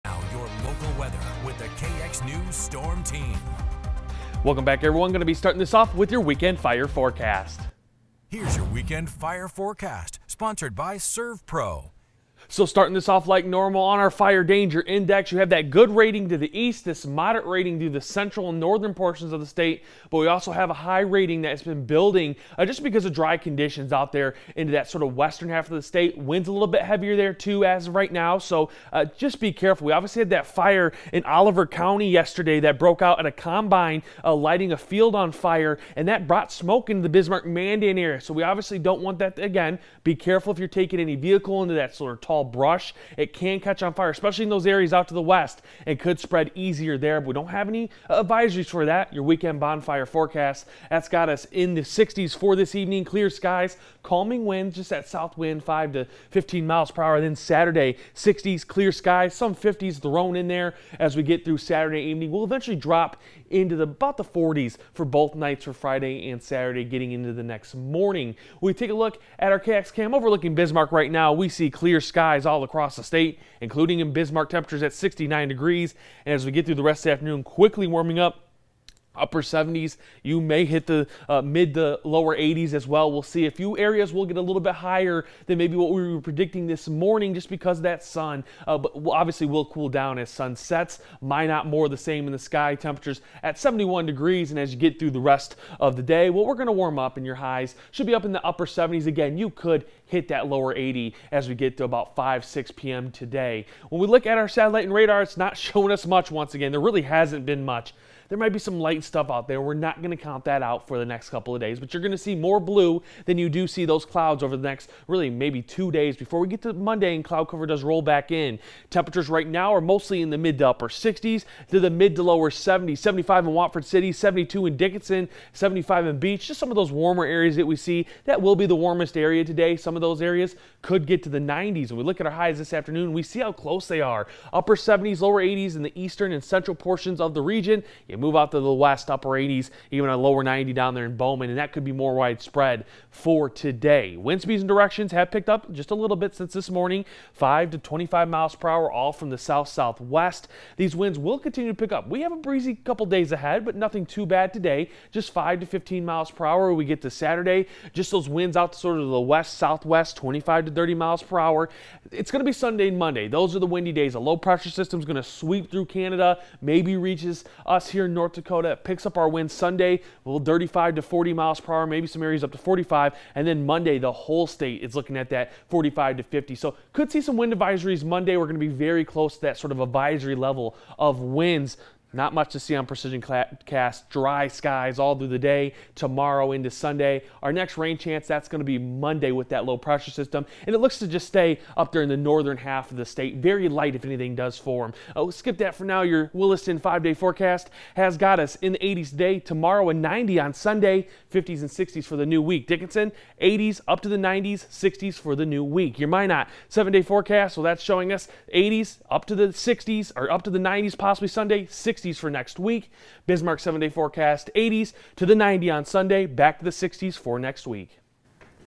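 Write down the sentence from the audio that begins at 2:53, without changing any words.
And then Monday, the whole state is looking at that 45 to 50.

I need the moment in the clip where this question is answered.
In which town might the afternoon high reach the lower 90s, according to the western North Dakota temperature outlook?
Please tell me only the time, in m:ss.
2:21.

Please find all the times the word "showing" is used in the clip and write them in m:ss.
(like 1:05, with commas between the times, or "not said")
1:45, 3:27.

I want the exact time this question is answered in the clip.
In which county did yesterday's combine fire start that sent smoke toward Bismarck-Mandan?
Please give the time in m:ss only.
0:31.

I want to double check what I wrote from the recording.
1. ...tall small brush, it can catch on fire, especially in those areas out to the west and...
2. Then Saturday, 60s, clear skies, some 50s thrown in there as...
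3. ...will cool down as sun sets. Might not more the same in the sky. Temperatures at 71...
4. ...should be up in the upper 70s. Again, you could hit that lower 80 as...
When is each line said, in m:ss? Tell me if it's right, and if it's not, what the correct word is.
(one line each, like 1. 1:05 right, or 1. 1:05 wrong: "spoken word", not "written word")
1. 0:42 right
2. 0:57 right
3. 1:29 right
4. 1:37 right.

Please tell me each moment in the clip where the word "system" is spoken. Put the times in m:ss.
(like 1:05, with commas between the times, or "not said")
2:44, 3:10.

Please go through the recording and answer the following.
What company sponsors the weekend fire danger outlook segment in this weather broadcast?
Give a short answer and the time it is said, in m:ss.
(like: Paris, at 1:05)
ServPro, at 0:10.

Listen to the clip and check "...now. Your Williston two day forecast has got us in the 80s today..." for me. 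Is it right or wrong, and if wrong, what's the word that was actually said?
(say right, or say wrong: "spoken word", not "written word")
wrong: "five", not "two".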